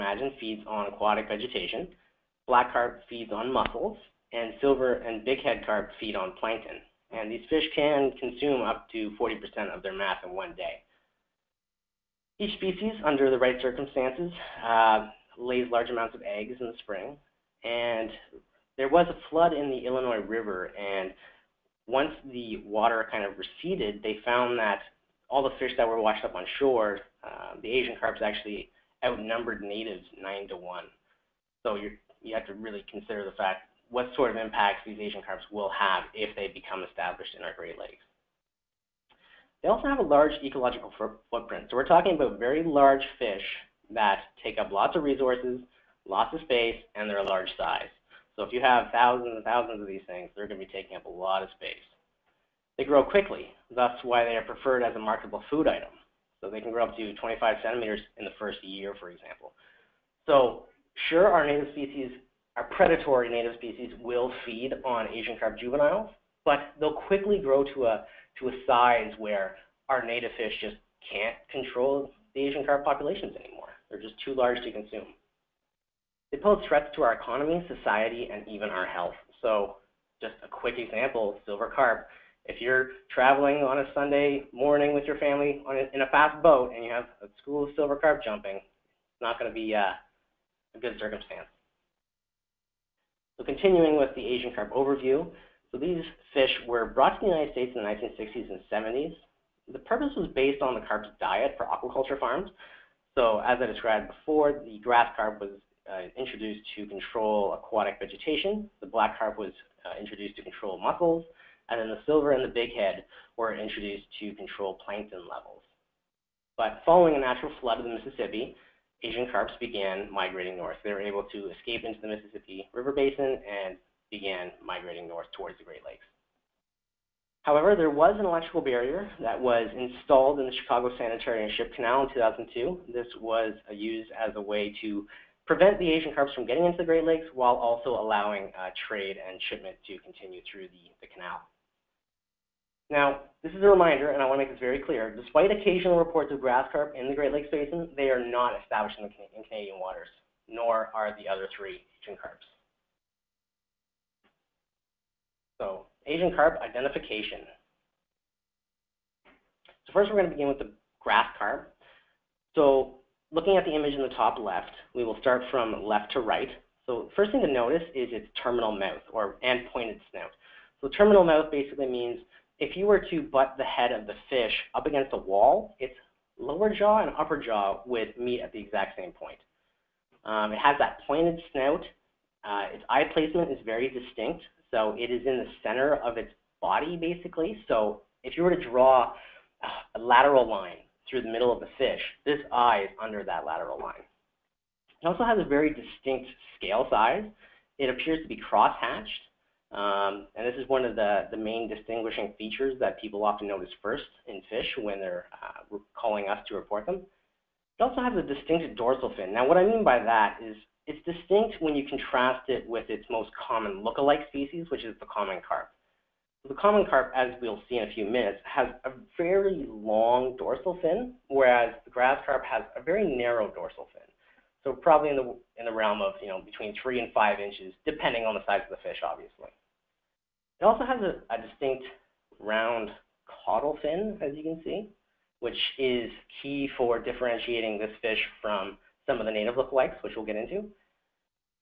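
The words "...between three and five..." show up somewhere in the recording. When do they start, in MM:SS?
03:46.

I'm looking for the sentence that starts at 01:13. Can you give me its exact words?
They're just too large to consume.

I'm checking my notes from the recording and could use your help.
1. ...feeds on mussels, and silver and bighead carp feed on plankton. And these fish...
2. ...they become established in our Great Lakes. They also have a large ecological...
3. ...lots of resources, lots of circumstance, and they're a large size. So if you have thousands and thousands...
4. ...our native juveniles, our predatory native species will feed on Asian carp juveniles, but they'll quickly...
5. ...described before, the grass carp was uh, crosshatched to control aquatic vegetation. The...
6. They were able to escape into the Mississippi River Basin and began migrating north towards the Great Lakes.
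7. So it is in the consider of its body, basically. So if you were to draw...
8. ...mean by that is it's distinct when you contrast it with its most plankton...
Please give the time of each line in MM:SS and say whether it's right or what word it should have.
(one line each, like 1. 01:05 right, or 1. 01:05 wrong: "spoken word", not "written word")
1. 00:03 right
2. 00:36 right
3. 00:44 wrong: "space", not "circumstance"
4. 01:01 wrong: "species", not "juveniles"
5. 01:43 wrong: "introduced", not "crosshatched"
6. 02:00 right
7. 03:04 wrong: "center", not "consider"
8. 03:29 wrong: "common", not "plankton".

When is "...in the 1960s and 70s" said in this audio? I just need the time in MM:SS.
01:37.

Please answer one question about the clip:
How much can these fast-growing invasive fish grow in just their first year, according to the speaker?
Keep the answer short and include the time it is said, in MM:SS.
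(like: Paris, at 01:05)
25 centimeters, at 00:57.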